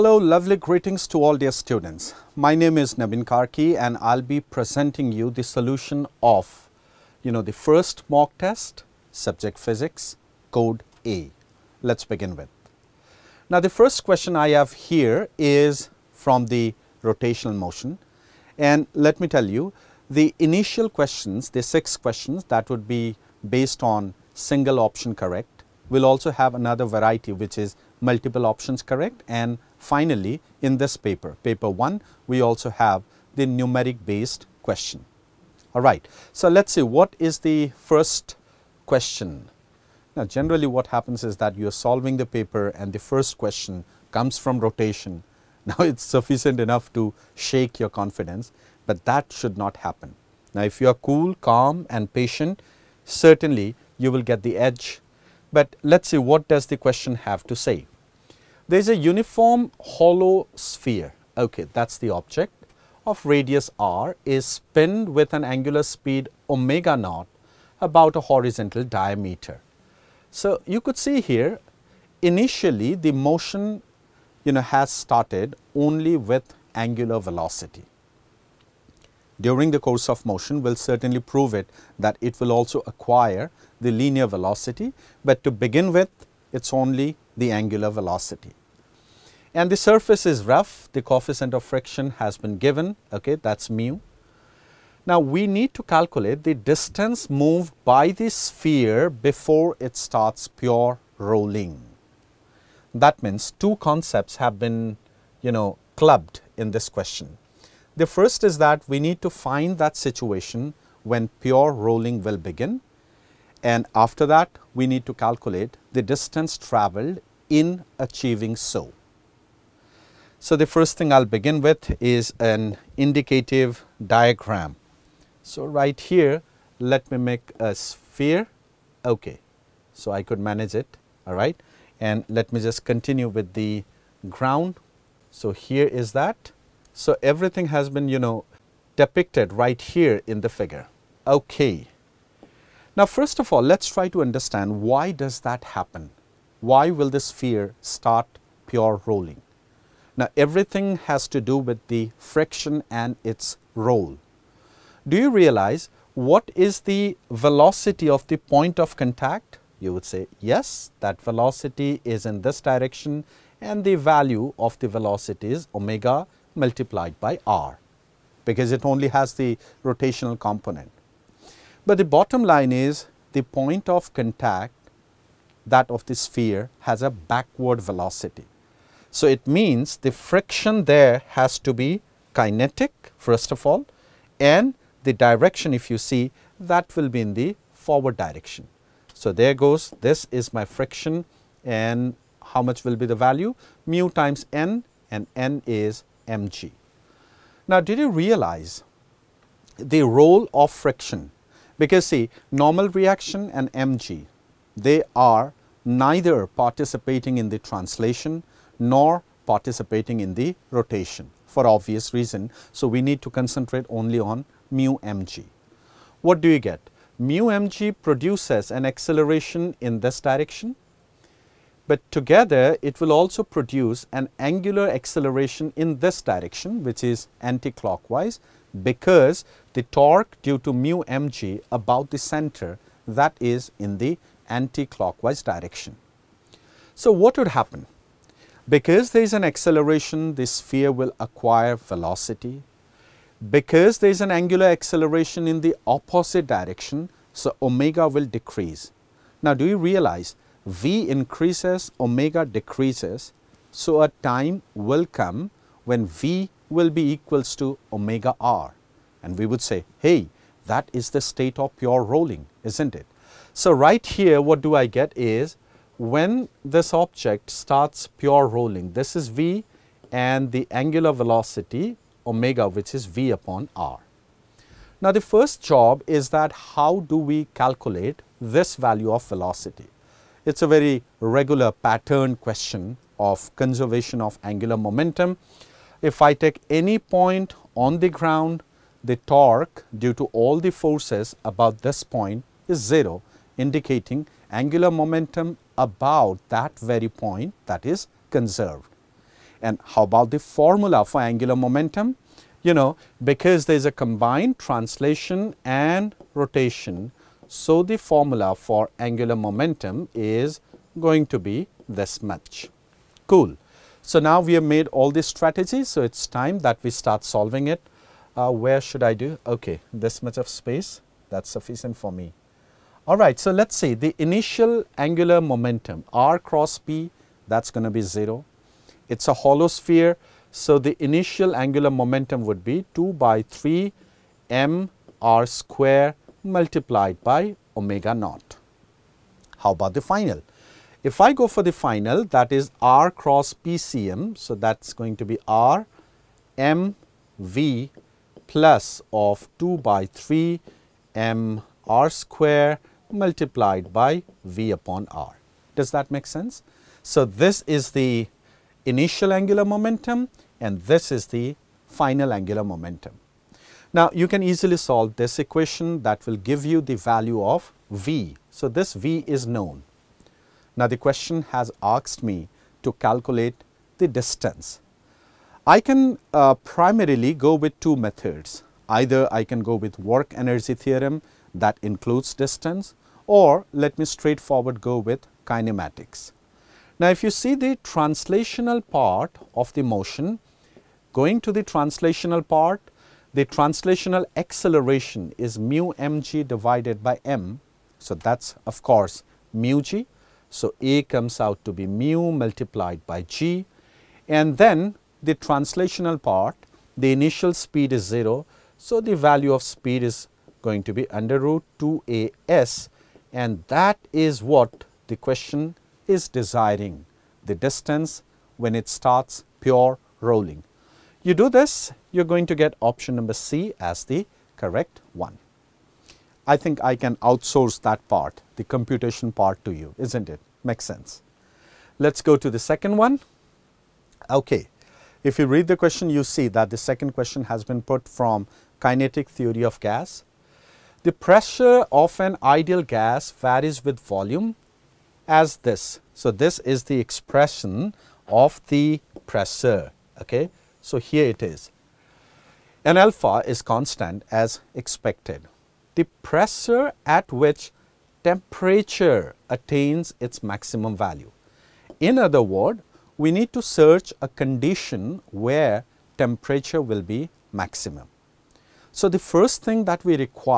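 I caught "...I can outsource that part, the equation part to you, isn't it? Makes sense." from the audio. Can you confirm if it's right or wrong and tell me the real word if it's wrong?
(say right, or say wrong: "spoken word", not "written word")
wrong: "computation", not "equation".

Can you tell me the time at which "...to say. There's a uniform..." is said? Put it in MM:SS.
00:57.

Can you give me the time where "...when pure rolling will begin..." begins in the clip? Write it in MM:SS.
01:51.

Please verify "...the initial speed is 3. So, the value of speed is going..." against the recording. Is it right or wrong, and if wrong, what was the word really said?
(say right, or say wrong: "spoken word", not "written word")
wrong: "0", not "3".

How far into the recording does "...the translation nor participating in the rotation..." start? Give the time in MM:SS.
03:27.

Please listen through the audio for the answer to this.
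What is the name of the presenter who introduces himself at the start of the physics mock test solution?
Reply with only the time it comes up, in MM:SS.
00:02.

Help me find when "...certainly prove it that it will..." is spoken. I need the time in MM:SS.
01:20.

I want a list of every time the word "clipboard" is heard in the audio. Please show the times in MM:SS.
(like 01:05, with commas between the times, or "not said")
not said.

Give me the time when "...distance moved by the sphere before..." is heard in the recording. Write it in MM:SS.
01:36.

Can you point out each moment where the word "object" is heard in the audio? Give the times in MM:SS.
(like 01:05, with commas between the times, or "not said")
01:02, 04:26.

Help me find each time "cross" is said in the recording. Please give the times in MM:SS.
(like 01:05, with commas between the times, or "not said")
05:26, 05:43.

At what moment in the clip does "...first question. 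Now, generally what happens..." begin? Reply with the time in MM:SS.
00:37.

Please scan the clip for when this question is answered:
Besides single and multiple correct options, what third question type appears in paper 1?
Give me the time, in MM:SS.
00:33.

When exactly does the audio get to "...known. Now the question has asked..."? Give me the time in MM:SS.
06:09.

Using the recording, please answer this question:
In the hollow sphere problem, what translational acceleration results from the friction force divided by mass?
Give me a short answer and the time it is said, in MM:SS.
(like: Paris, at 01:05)
mu g, at 06:41.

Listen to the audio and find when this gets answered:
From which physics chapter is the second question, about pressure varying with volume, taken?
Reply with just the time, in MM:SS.
07:18.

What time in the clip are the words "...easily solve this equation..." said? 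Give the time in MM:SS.
06:04.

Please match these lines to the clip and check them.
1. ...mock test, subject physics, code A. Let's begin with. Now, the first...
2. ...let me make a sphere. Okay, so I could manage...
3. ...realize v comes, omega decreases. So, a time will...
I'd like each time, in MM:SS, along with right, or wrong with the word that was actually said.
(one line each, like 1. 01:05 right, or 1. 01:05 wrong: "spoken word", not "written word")
1. 00:08 right
2. 02:06 right
3. 04:09 wrong: "increases", not "comes".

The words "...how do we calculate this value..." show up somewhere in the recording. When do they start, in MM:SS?
04:36.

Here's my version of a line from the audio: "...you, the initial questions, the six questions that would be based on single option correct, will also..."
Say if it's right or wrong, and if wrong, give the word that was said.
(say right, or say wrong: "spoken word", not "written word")
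right.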